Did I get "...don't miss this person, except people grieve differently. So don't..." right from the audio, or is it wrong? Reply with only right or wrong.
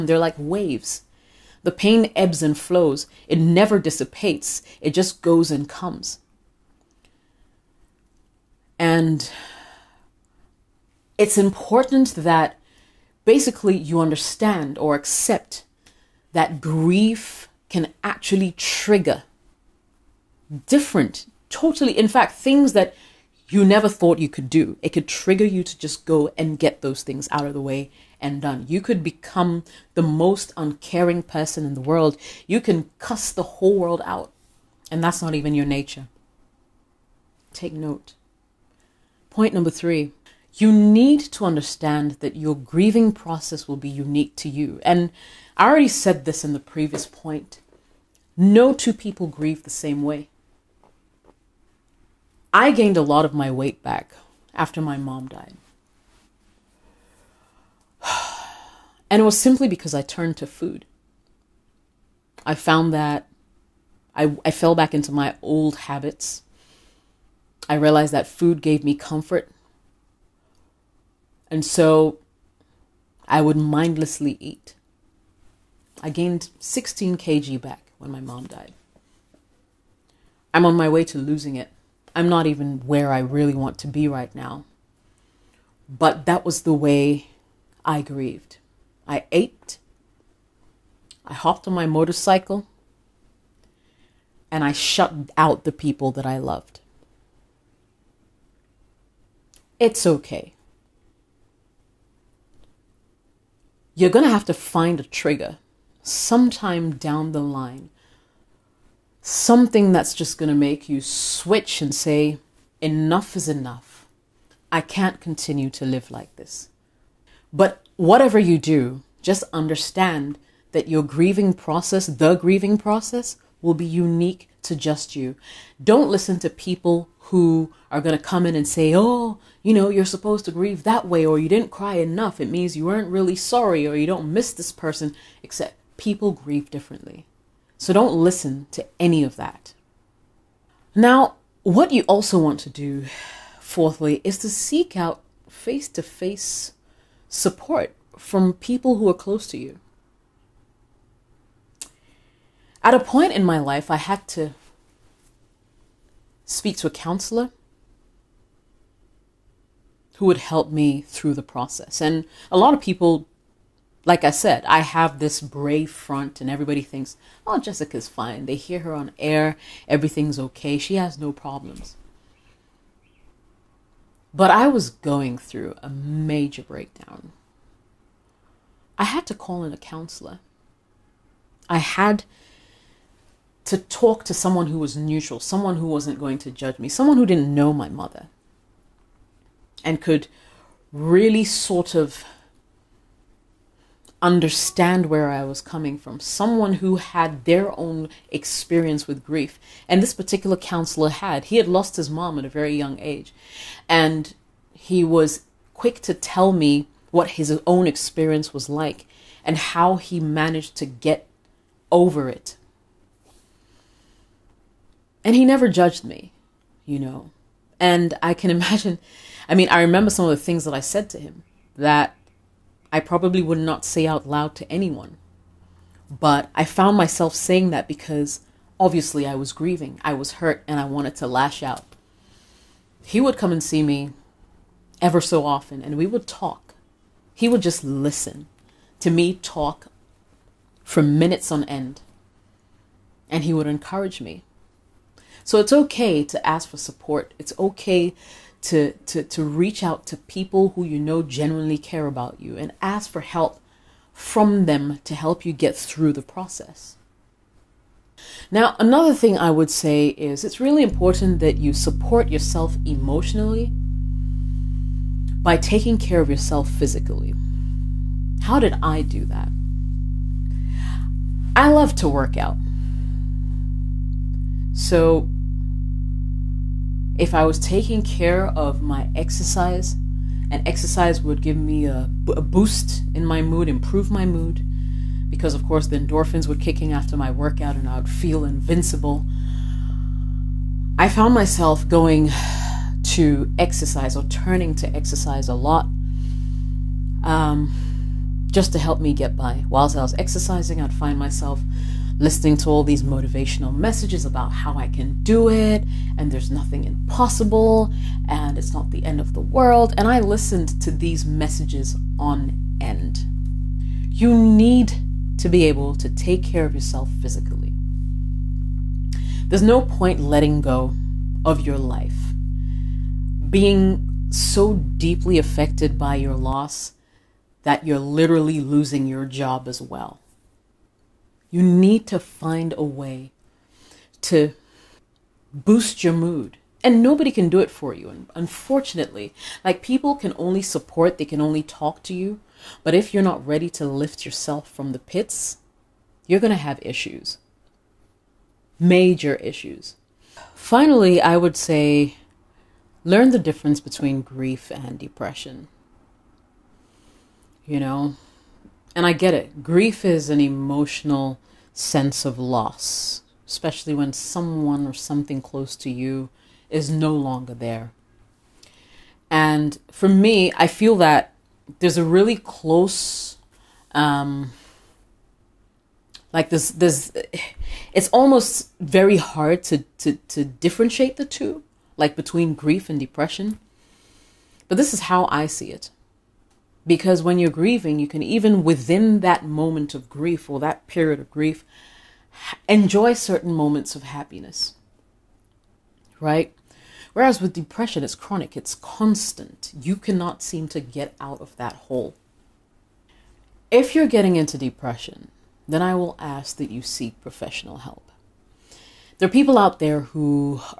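right.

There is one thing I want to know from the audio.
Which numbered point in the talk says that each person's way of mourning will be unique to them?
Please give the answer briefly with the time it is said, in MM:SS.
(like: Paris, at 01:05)
3, at 00:39.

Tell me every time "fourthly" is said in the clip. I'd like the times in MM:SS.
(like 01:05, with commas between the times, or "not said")
02:23.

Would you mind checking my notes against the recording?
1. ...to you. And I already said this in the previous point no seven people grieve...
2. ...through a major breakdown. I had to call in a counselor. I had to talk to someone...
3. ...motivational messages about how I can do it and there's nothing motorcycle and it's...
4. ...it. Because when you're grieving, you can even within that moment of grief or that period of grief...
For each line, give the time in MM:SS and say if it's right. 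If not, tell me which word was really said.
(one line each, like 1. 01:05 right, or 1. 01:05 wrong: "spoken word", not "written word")
1. 00:44 wrong: "two", not "seven"
2. 02:55 right
3. 05:03 wrong: "impossible", not "motorcycle"
4. 06:25 right.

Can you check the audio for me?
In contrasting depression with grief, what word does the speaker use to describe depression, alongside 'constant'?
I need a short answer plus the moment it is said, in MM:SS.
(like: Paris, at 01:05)
chronic, at 06:38.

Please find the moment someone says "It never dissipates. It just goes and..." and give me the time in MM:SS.
00:03.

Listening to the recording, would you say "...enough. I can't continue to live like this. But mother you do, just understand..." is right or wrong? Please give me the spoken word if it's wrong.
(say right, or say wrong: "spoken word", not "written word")
wrong: "whatever", not "mother".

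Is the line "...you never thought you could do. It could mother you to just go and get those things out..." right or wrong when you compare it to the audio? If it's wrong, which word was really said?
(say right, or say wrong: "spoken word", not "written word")
wrong: "trigger", not "mother".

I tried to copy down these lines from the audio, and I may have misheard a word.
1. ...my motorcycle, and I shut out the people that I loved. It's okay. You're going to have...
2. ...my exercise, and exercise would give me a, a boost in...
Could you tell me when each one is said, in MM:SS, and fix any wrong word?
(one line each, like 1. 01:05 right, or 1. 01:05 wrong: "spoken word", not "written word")
1. 01:31 right
2. 04:38 right.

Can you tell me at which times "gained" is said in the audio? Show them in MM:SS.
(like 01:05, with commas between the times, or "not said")
00:52, 01:16.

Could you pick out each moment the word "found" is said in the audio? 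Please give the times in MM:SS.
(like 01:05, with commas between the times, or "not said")
01:02, 03:46, 04:51.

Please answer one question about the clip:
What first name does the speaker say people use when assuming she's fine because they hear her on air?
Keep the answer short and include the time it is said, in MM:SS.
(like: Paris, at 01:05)
Jessica, at 02:47.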